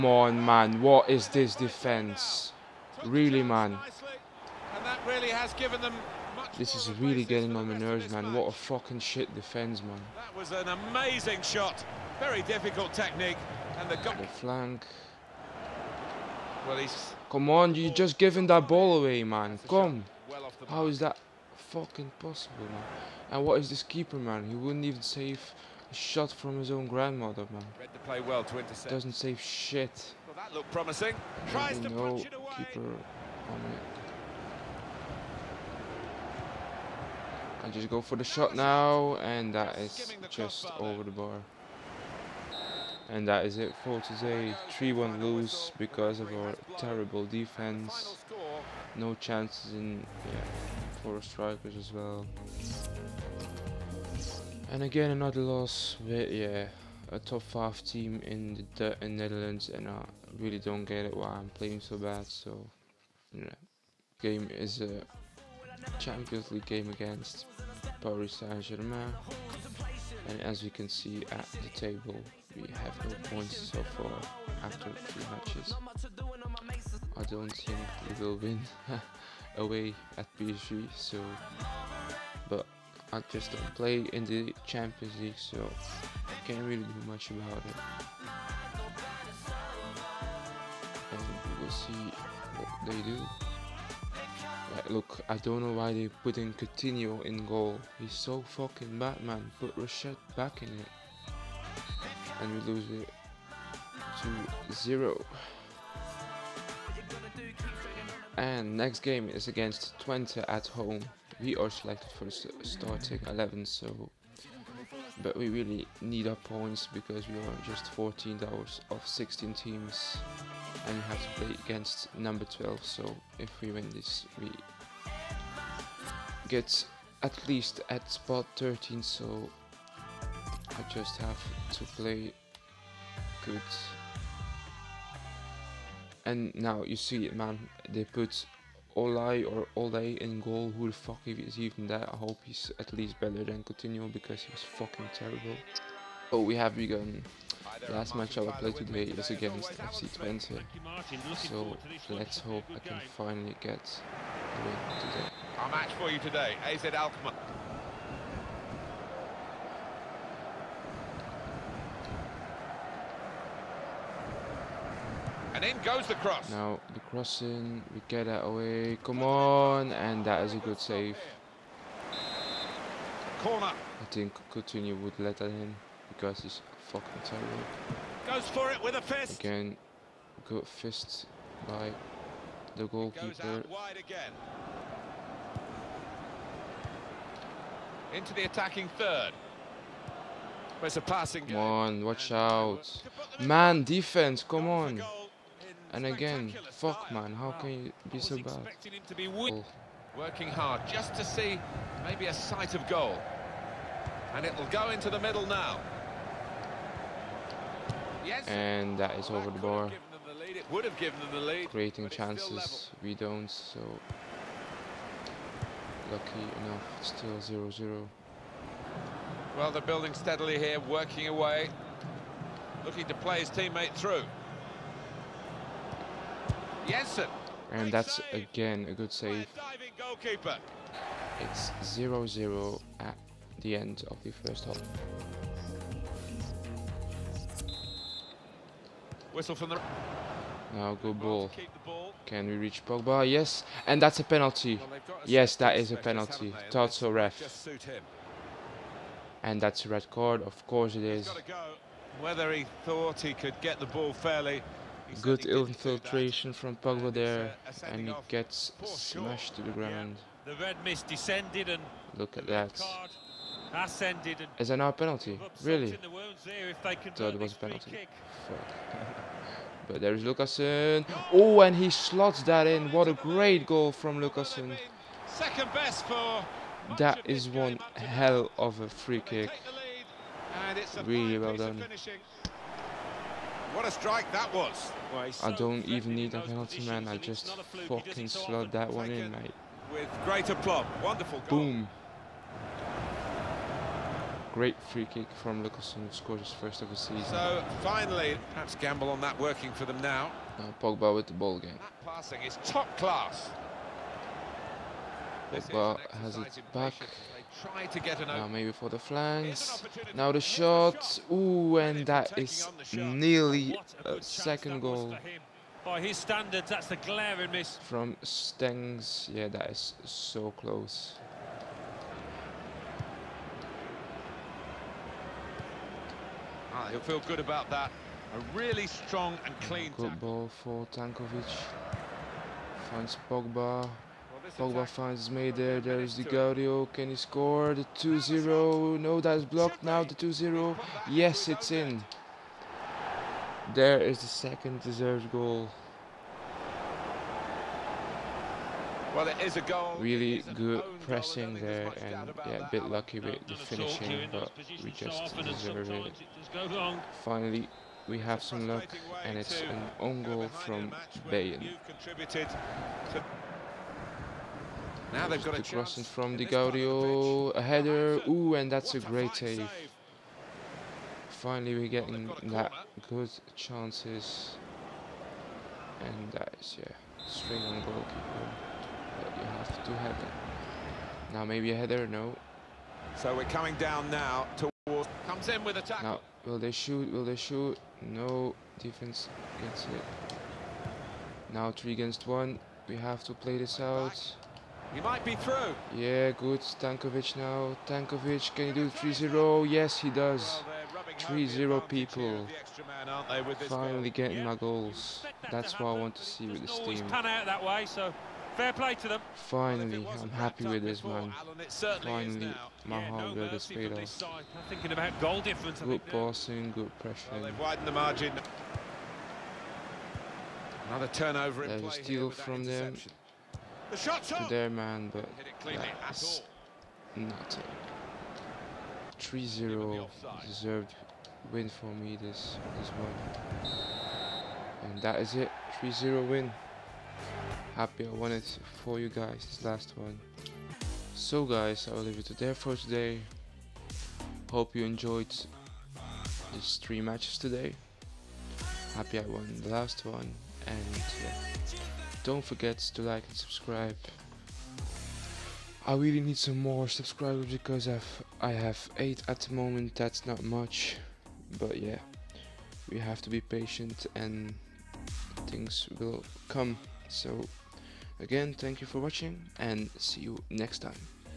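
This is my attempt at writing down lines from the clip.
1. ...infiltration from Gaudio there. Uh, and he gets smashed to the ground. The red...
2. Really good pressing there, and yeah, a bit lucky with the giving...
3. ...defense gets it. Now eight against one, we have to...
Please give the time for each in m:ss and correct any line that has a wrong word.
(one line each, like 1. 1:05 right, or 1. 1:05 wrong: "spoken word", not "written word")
1. 4:15 wrong: "Pogba", not "Gaudio"
2. 5:49 wrong: "finishing", not "giving"
3. 6:28 wrong: "three", not "eight".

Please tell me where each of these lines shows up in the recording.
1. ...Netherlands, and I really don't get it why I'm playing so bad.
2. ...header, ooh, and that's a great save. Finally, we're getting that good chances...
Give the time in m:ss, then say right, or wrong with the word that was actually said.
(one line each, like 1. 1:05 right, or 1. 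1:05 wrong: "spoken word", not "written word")
1. 0:59 right
2. 6:07 right.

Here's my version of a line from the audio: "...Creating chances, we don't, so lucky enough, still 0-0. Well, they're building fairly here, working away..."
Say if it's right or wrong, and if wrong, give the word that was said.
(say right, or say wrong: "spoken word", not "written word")
wrong: "steadily", not "fairly".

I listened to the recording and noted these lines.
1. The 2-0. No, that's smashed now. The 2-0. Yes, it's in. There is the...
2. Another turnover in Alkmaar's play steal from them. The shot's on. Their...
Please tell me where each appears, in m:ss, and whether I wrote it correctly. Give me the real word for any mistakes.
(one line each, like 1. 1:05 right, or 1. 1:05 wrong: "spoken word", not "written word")
1. 5:37 wrong: "blocked", not "smashed"
2. 7:00 wrong: "There", not "Alkmaar".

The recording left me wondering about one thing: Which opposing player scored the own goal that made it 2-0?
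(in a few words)
Bayon.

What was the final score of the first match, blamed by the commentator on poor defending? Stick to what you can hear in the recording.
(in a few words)
3-1.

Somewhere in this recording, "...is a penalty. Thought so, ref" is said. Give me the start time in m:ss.
4:05.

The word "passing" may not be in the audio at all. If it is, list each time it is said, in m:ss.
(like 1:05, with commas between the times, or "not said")
3:11, 5:02, 6:56.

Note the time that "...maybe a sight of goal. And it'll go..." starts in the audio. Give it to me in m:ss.
3:22.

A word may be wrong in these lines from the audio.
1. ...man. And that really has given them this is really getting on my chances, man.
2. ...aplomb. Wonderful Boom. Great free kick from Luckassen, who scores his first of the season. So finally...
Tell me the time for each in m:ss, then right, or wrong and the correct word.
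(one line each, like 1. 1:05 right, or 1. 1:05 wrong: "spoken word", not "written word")
1. 0:03 wrong: "nerves", not "chances"
2. 4:50 right.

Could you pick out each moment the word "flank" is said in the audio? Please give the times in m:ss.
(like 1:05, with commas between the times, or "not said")
0:14, 5:08.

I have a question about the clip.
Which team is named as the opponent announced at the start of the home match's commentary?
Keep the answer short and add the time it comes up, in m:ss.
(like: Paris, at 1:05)
AZ Alkmaar, at 2:36.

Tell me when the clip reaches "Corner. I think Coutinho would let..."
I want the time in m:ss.
2:53.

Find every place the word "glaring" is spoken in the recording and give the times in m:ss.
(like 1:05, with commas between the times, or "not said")
5:16.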